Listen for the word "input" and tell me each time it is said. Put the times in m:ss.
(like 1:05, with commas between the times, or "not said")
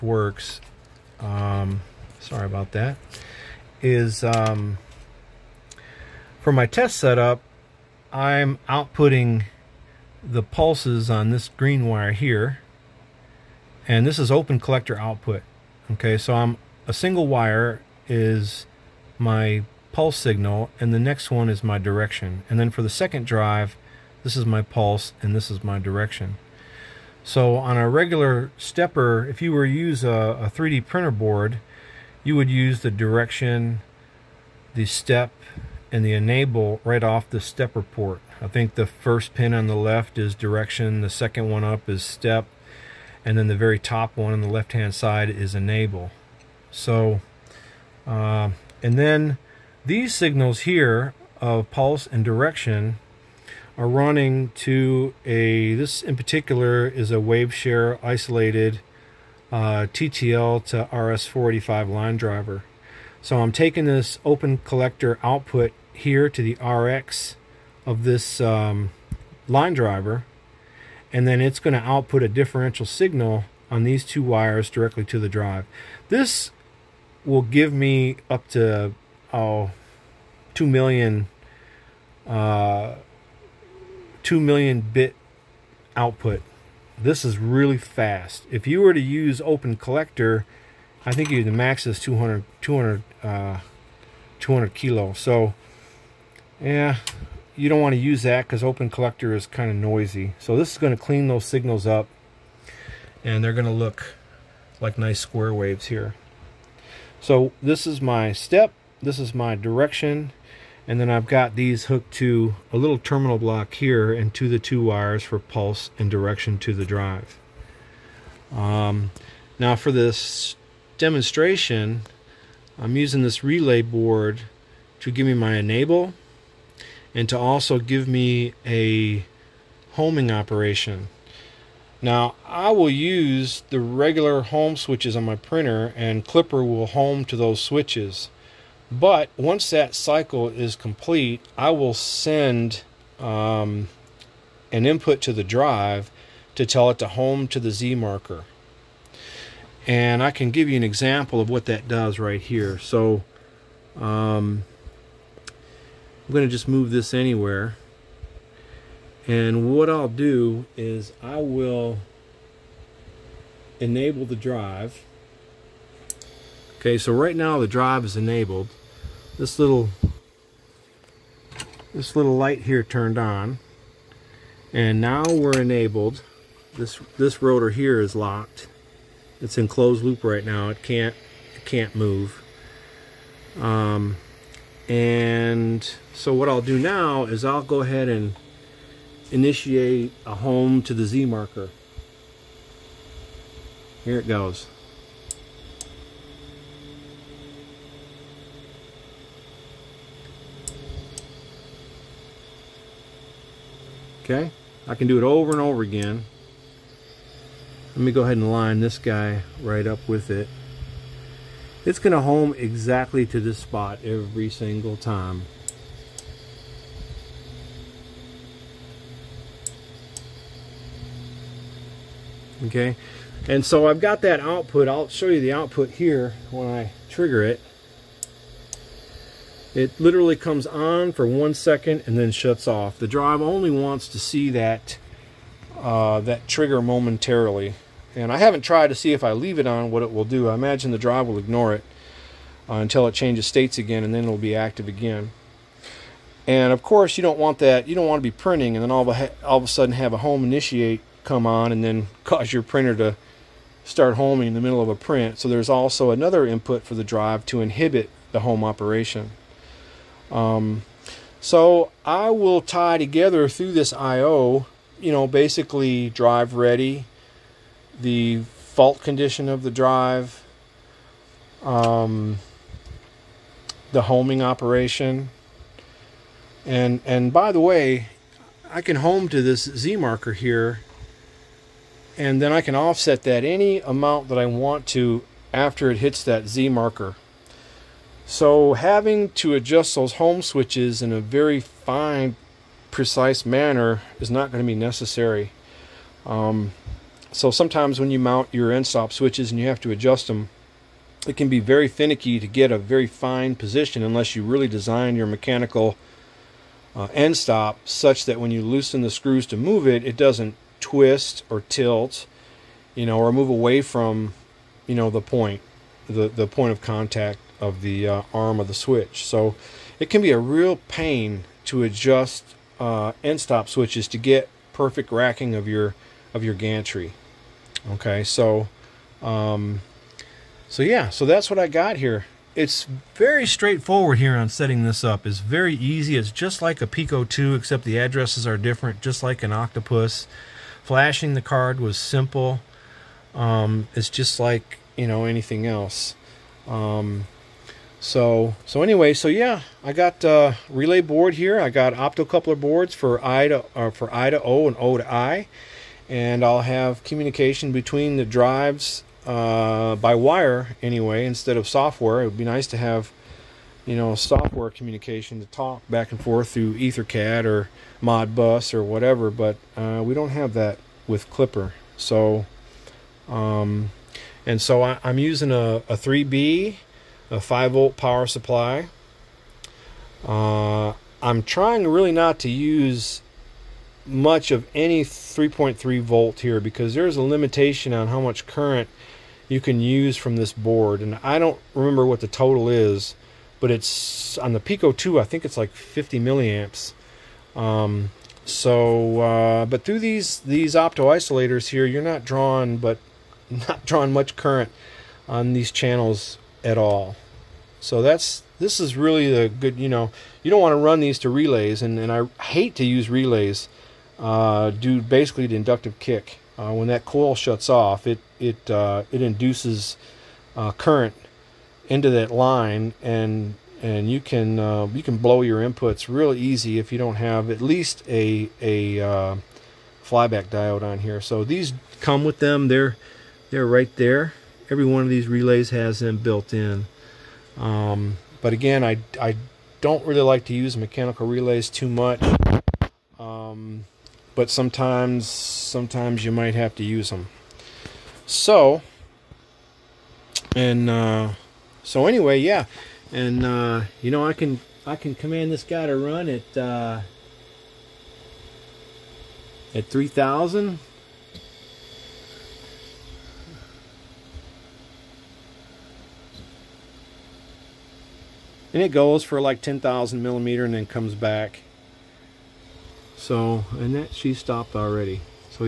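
2:24, 4:16, 7:05.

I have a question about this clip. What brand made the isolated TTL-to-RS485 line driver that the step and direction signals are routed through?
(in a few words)
WaveShare.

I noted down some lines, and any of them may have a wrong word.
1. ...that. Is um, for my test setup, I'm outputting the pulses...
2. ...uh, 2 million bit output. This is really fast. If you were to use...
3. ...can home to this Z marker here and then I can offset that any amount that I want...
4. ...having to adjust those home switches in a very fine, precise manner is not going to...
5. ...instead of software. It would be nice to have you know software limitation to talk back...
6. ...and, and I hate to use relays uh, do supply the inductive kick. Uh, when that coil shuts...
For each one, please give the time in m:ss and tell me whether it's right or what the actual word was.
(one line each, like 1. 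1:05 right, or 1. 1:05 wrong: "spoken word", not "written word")
1. 0:02 right
2. 1:22 right
3. 4:38 right
4. 4:48 right
5. 6:01 wrong: "communication", not "limitation"
6. 6:51 wrong: "basically", not "supply".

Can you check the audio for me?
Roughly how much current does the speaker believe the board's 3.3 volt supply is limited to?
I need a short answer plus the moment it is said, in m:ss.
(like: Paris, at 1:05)
50 milliamps, at 6:35.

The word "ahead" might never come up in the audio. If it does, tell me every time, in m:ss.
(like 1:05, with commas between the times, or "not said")
3:07, 3:28.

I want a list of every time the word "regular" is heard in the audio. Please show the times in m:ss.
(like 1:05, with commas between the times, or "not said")
0:27, 2:13.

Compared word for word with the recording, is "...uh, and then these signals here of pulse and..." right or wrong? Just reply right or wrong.
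right.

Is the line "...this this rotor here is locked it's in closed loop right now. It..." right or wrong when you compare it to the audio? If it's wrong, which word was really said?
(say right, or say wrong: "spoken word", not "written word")
right.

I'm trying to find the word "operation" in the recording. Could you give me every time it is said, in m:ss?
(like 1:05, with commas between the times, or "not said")
2:10, 4:18, 4:34.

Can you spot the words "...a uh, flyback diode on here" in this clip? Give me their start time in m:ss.
7:08.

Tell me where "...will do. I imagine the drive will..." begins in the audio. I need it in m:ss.
4:00.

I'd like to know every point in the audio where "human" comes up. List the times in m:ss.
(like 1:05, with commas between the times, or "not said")
not said.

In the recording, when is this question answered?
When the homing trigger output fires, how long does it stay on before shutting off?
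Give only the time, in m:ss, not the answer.
3:51.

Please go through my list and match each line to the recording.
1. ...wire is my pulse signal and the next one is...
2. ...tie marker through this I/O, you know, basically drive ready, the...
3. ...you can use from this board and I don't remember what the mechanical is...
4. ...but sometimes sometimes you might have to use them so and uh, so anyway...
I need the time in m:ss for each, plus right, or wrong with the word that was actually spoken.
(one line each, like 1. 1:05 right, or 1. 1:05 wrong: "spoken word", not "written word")
1. 0:17 right
2. 4:22 wrong: "together", not "marker"
3. 6:29 wrong: "total", not "mechanical"
4. 7:24 right.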